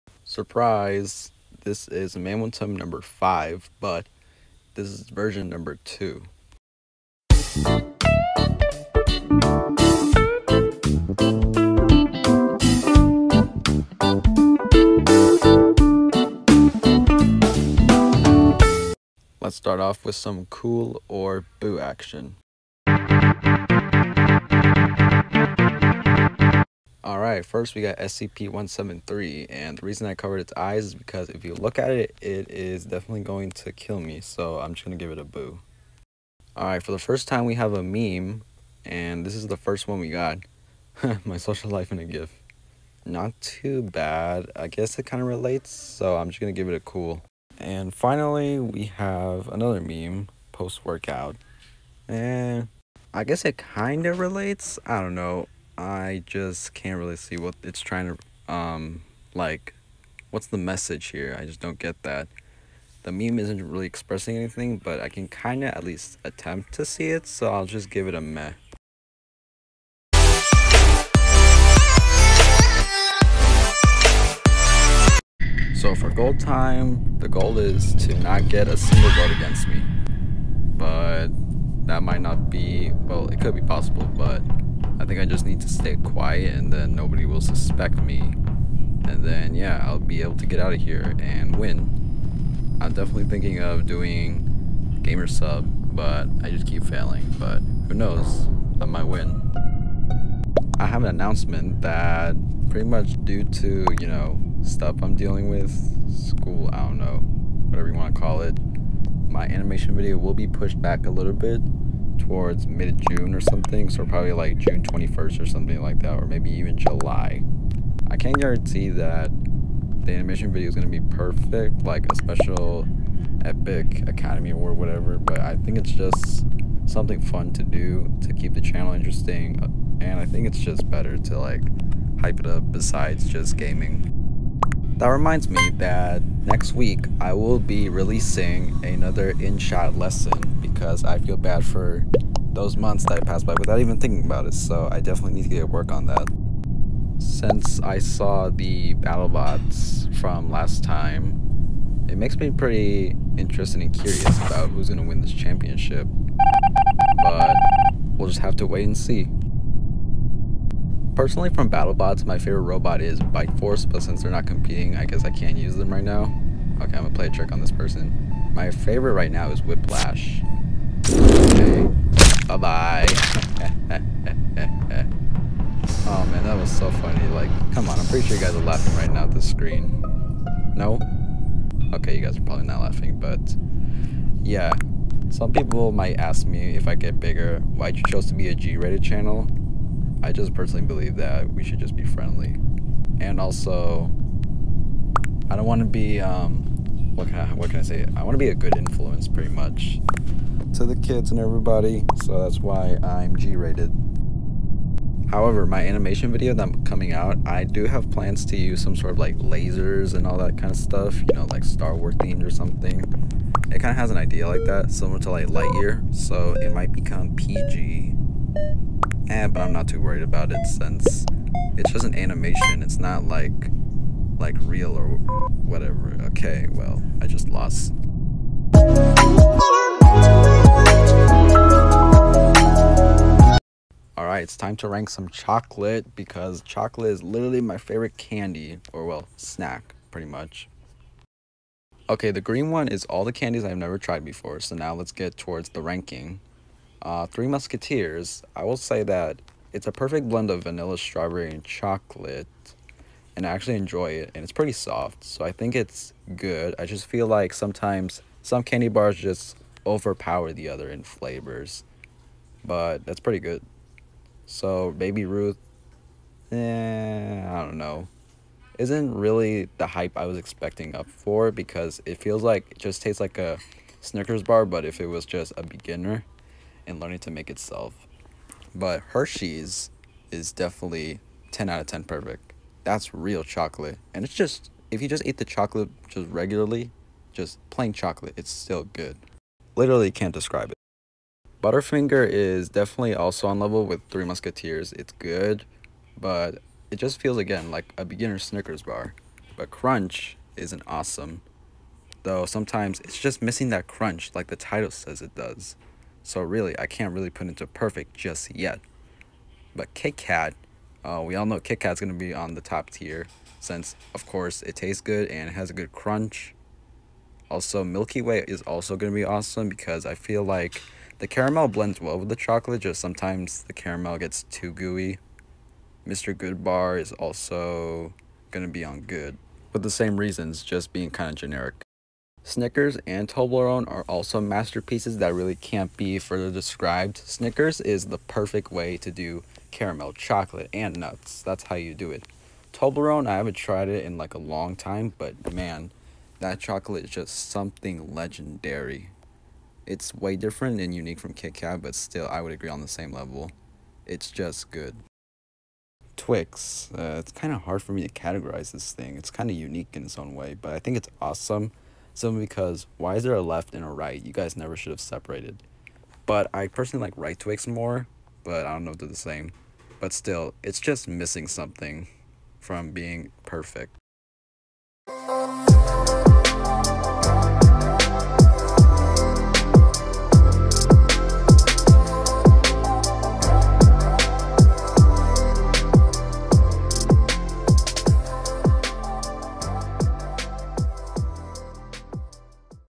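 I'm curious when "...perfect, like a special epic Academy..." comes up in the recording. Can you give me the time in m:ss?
2:01.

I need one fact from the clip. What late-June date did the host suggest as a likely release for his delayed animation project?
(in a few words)
June 21st.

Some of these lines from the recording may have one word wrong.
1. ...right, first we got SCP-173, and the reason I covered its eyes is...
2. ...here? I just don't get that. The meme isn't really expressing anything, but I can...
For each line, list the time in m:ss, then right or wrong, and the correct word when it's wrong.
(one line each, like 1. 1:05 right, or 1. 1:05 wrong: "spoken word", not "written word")
1. 0:27 right
2. 1:01 right.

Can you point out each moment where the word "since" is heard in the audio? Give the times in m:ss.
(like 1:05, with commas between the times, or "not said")
2:27, 2:44, 3:40, 5:13.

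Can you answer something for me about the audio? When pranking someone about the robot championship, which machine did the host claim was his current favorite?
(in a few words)
Whiplash.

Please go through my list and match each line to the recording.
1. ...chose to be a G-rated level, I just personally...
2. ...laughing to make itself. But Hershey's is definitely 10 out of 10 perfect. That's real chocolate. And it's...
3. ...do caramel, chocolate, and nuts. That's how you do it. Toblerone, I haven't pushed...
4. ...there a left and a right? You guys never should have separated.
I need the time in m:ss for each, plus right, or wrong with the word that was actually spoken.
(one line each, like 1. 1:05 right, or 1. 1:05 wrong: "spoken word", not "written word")
1. 3:08 wrong: "channel", not "level"
2. 4:36 wrong: "learning", not "laughing"
3. 5:39 wrong: "tried", not "pushed"
4. 6:03 right.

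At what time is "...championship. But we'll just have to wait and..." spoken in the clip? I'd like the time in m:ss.
2:35.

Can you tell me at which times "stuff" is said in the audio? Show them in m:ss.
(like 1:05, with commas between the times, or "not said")
1:44, 3:30.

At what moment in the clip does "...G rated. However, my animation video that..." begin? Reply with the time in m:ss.
3:23.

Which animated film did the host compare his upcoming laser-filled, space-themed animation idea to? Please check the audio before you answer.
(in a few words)
Lightyear.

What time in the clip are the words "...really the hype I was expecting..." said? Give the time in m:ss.
4:29.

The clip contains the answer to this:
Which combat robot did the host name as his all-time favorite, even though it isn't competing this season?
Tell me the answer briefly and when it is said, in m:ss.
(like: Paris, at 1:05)
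Bite Force, at 2:43.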